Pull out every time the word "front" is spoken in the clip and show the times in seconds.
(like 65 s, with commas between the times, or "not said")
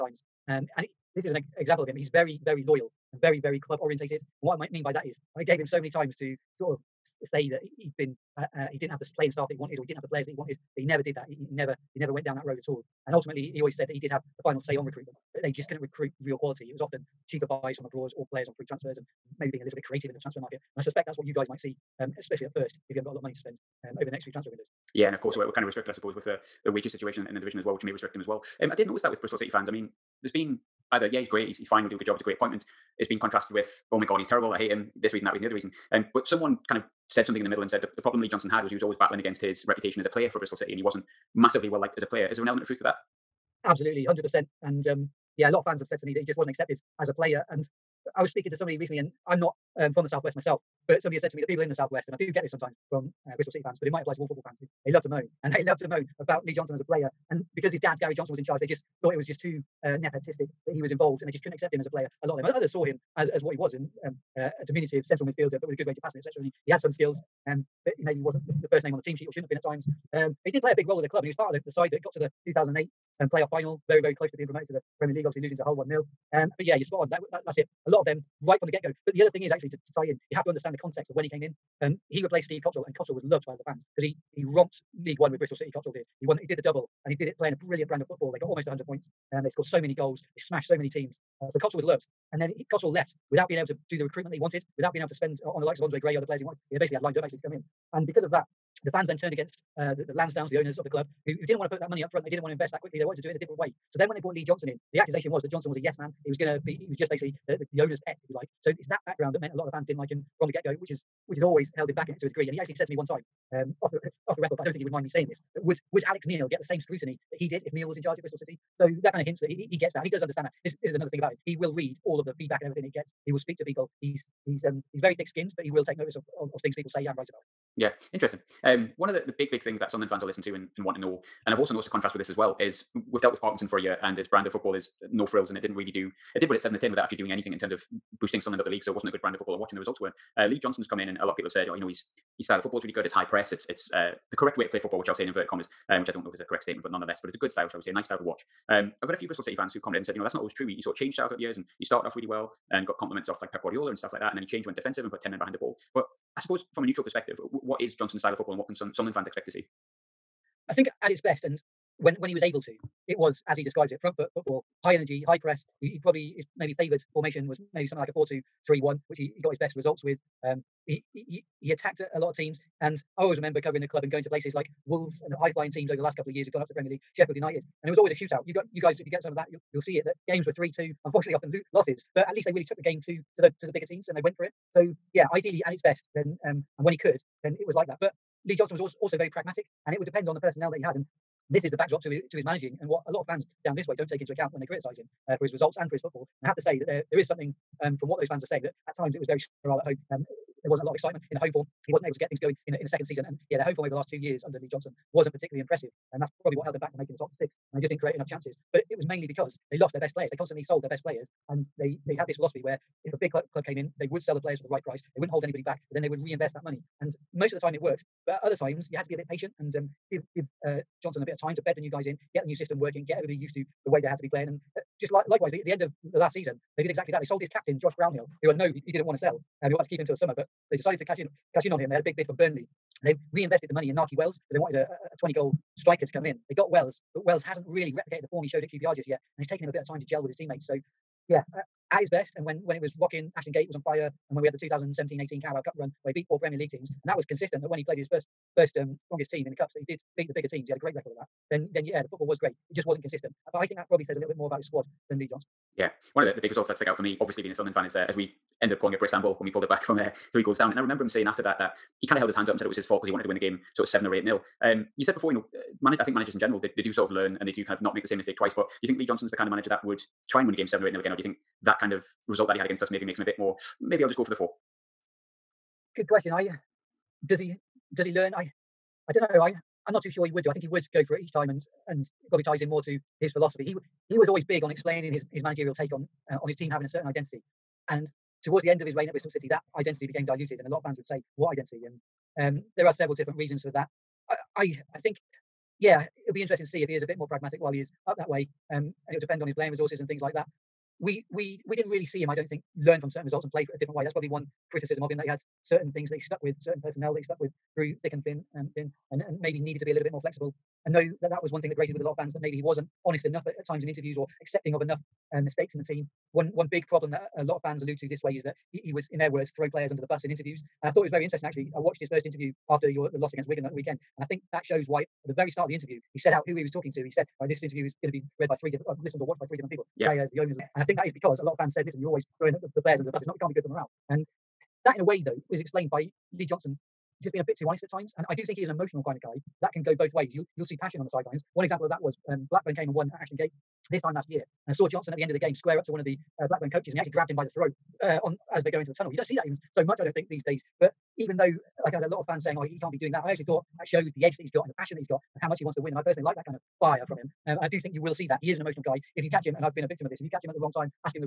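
102 s, 164 s.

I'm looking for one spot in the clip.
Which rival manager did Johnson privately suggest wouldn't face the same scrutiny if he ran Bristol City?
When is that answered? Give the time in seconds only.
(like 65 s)
116 s.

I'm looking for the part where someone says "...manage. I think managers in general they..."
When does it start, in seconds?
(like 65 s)
265 s.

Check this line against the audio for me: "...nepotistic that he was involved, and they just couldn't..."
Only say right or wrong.
right.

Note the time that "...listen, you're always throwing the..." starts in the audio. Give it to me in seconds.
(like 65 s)
331 s.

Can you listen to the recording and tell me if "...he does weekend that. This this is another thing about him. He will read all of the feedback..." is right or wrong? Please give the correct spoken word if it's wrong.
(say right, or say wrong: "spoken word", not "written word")
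wrong: "understand", not "weekend".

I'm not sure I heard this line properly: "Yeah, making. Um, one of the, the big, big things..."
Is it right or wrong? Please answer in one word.
wrong.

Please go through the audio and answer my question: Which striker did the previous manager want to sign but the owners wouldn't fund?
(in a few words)
Andre Gray.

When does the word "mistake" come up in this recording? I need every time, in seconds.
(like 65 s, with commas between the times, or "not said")
268 s, 315 s.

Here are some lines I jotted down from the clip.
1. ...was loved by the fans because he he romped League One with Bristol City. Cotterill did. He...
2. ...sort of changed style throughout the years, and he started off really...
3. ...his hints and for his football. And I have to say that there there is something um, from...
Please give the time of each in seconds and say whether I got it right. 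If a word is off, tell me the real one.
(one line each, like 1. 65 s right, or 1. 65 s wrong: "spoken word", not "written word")
1. 83 s right
2. 150 s right
3. 195 s wrong: "results", not "hints".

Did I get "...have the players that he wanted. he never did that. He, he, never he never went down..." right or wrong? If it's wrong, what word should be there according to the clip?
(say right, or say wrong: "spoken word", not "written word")
right.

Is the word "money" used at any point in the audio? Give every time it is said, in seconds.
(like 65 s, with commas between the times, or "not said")
23 s, 101 s, 216 s, 233 s.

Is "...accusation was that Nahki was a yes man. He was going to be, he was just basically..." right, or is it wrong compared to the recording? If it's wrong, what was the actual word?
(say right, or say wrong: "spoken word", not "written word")
wrong: "Johnson", not "Nahki".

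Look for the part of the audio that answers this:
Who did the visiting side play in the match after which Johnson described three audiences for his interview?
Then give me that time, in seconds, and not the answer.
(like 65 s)
323 s.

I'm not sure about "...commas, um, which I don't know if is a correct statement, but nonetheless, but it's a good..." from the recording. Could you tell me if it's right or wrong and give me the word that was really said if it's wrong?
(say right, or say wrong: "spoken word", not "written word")
right.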